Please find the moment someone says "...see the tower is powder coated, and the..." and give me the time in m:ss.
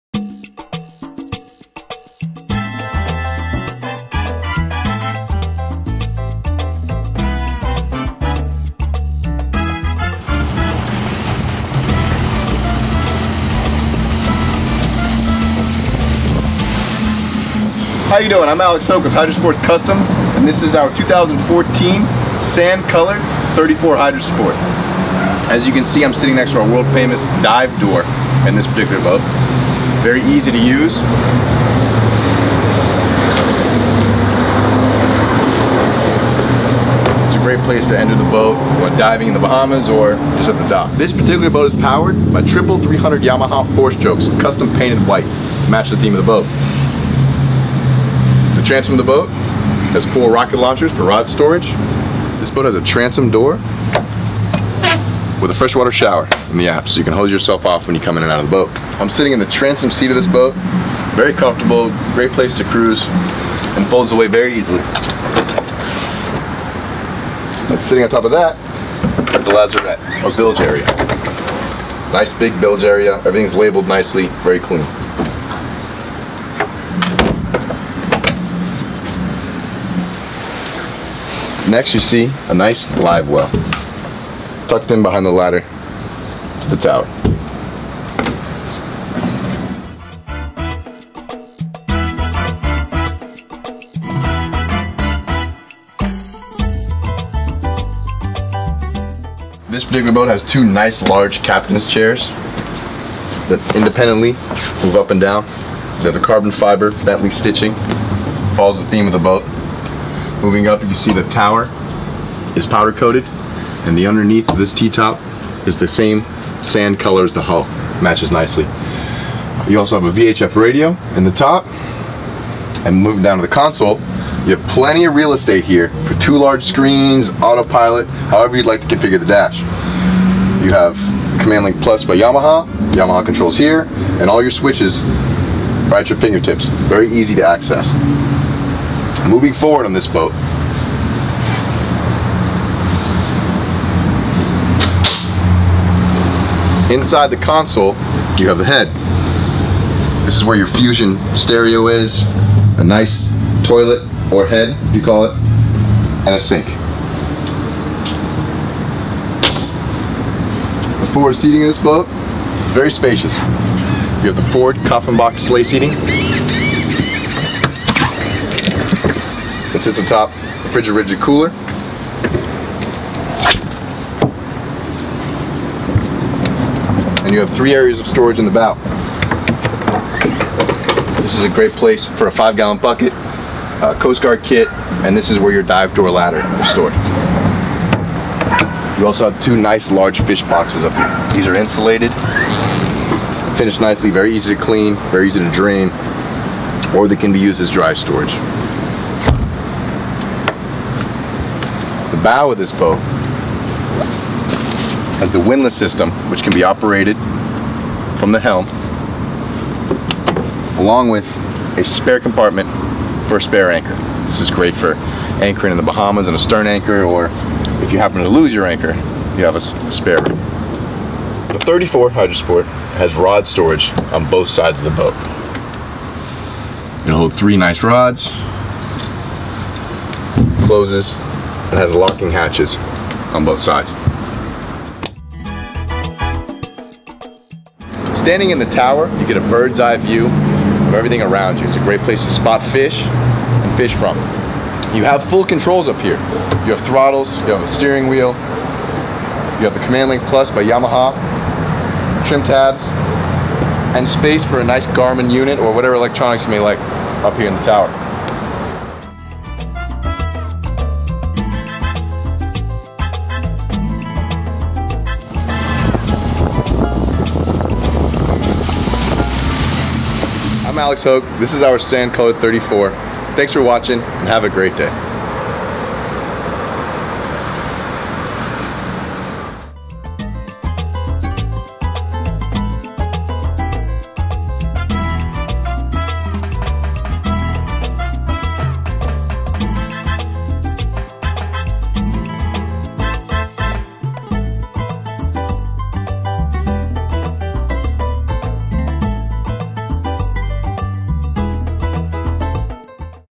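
1:50.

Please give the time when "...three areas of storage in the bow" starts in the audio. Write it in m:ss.
2:57.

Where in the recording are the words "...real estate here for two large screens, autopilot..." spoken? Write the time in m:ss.
2:05.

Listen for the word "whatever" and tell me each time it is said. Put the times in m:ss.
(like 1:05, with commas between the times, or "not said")
4:15.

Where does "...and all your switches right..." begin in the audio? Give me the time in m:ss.
2:14.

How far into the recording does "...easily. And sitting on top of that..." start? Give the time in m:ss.
1:04.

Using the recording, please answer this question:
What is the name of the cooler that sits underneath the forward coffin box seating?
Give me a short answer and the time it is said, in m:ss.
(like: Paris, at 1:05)
Frigid Rigid, at 2:50.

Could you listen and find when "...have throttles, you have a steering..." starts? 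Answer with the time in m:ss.
4:06.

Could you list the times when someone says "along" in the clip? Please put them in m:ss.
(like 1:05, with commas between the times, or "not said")
3:30.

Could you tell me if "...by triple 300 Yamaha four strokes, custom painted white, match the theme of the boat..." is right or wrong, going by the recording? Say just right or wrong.
right.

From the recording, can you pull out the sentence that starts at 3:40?
The 34 Hydra Sport has rod storage on both sides of the boat.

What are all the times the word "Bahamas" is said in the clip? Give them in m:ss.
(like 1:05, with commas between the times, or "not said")
0:39, 3:35.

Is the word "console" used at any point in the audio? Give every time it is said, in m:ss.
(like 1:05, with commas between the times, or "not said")
2:03, 2:27.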